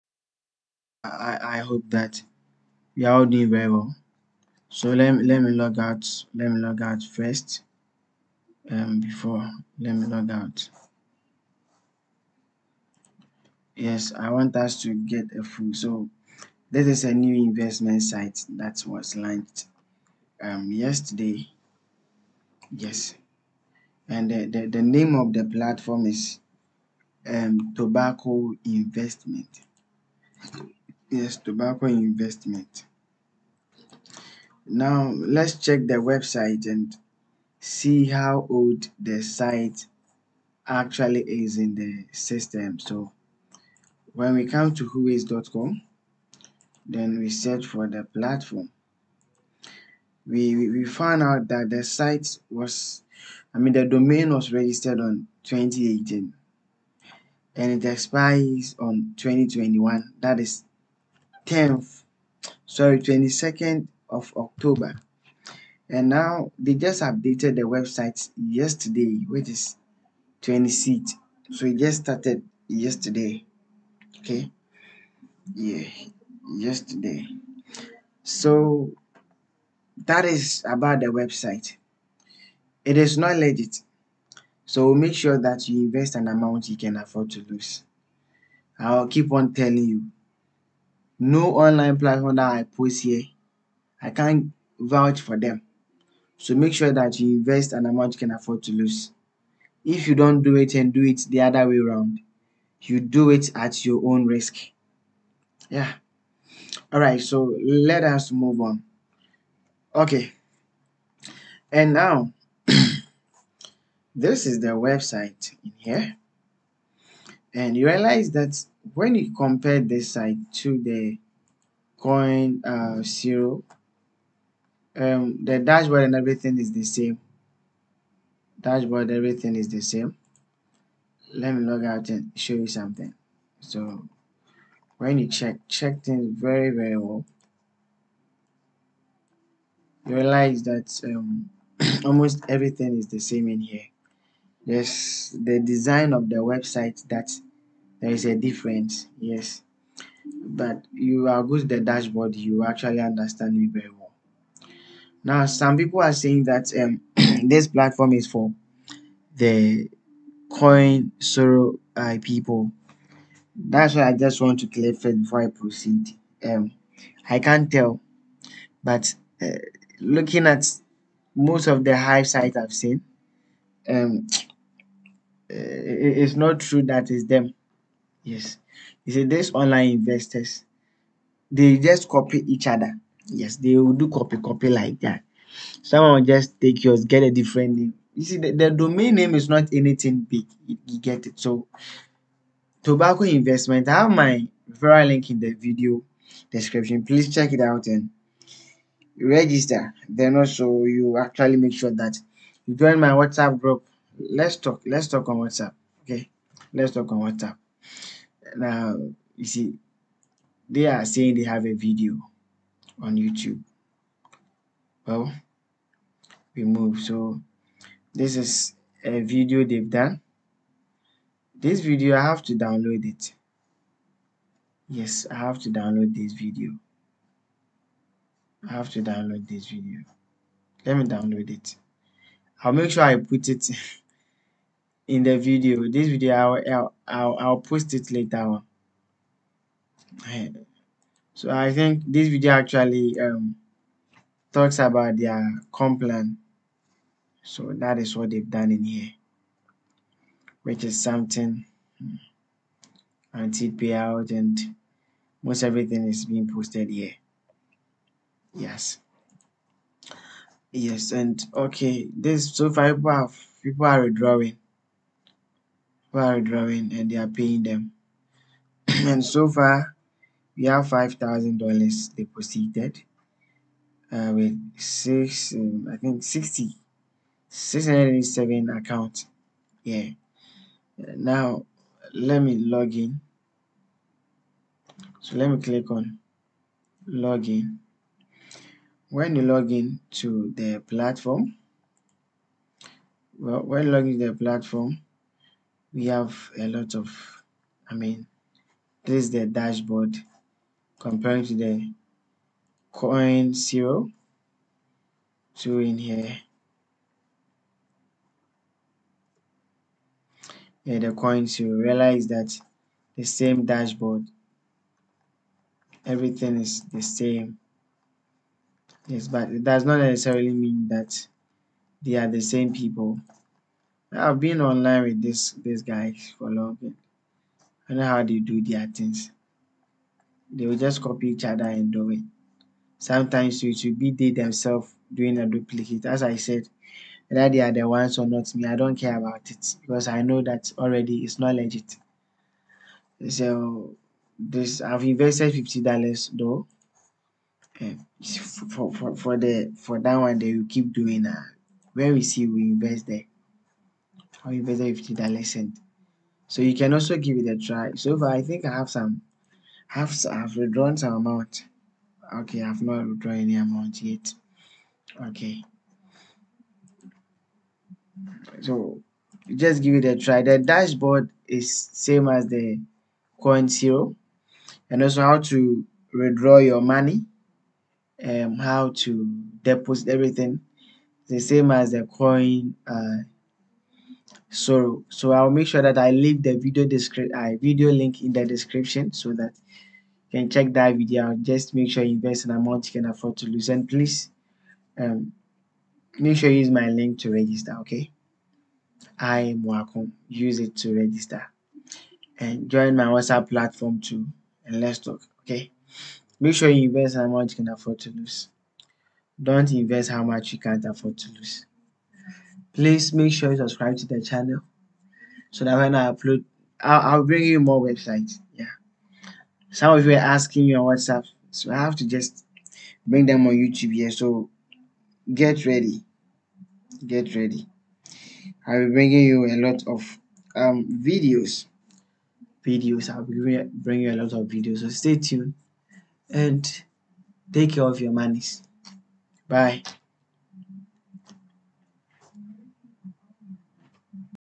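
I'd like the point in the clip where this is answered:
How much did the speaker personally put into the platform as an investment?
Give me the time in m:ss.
5:45.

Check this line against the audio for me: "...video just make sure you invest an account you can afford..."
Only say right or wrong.
wrong.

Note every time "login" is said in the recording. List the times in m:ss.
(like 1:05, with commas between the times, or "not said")
4:47.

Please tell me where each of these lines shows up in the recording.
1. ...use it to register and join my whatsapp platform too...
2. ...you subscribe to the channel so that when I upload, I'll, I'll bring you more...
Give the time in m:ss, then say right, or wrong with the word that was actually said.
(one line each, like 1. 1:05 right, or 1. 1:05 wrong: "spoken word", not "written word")
1. 6:40 right
2. 6:53 right.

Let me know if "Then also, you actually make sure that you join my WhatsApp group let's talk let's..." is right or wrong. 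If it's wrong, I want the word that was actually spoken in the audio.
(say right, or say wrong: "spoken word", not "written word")
right.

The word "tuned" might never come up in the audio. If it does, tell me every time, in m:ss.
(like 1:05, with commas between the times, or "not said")
7:15.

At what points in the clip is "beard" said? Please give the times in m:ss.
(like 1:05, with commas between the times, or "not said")
not said.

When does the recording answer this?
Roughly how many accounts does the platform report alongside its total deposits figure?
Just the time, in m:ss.
4:37.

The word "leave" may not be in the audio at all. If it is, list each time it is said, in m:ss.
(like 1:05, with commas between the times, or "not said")
6:26.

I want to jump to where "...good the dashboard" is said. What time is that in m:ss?
2:31.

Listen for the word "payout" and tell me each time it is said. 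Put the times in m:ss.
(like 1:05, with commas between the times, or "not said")
4:13.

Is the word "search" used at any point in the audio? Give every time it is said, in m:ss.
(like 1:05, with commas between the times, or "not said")
0:47.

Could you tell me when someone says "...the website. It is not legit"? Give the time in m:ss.
1:21.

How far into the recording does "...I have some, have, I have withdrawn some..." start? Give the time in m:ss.
5:58.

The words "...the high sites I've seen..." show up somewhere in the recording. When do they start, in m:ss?
2:51.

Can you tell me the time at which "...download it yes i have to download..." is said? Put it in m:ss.
3:42.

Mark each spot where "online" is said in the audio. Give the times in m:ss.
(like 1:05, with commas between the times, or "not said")
1:31, 2:59, 5:24.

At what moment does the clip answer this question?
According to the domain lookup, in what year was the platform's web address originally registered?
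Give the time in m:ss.
0:55.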